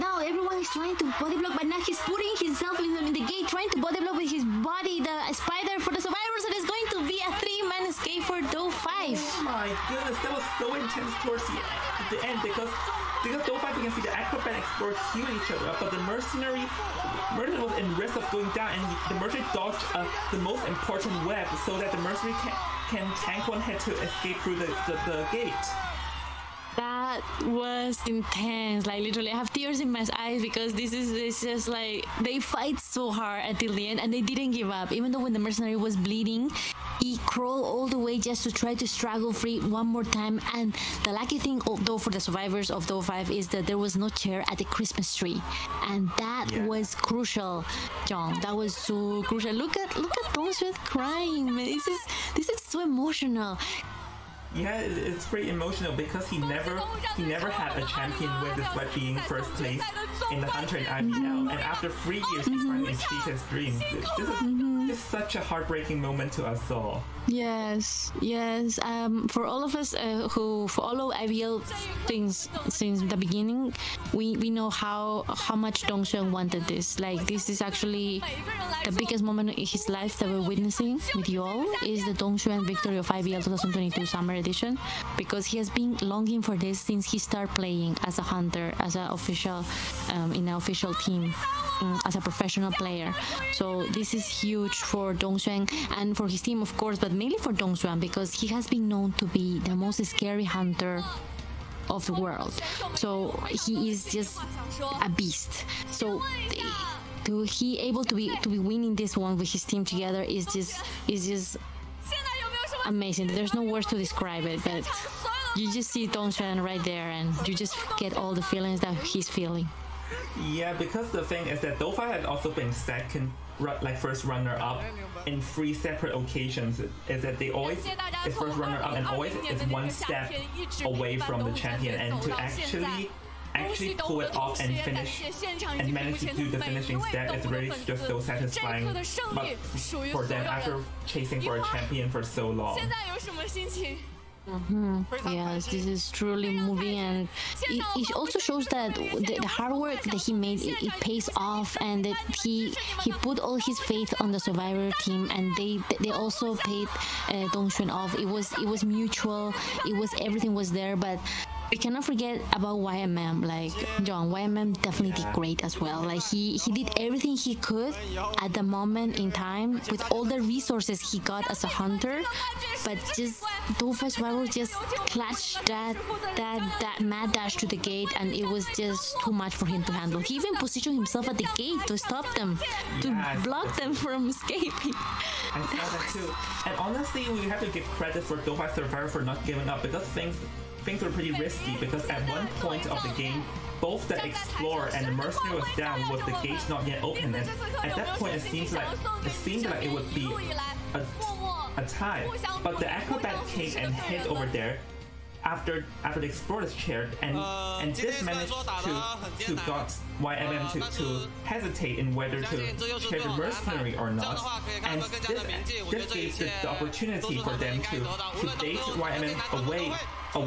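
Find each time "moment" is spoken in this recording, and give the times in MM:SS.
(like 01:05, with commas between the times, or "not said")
01:06, 01:19, 02:48.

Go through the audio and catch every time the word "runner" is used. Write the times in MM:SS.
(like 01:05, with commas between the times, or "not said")
02:04, 02:08.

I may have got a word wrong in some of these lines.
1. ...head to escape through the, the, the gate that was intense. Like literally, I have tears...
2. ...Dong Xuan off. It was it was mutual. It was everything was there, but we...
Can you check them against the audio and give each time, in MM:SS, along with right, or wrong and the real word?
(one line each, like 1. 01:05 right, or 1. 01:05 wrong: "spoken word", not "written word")
1. 00:23 right
2. 02:37 right.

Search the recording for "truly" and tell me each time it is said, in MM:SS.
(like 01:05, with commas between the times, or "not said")
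02:26.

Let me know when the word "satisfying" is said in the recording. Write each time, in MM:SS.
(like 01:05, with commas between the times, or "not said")
02:18.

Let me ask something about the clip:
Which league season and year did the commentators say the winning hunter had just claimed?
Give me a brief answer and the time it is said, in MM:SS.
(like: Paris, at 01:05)
IVL 2022 summer, at 01:23.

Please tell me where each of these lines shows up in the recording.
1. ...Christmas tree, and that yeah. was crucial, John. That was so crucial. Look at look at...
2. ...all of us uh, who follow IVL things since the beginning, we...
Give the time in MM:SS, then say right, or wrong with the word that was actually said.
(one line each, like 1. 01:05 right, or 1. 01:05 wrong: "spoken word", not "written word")
1. 00:44 right
2. 01:09 right.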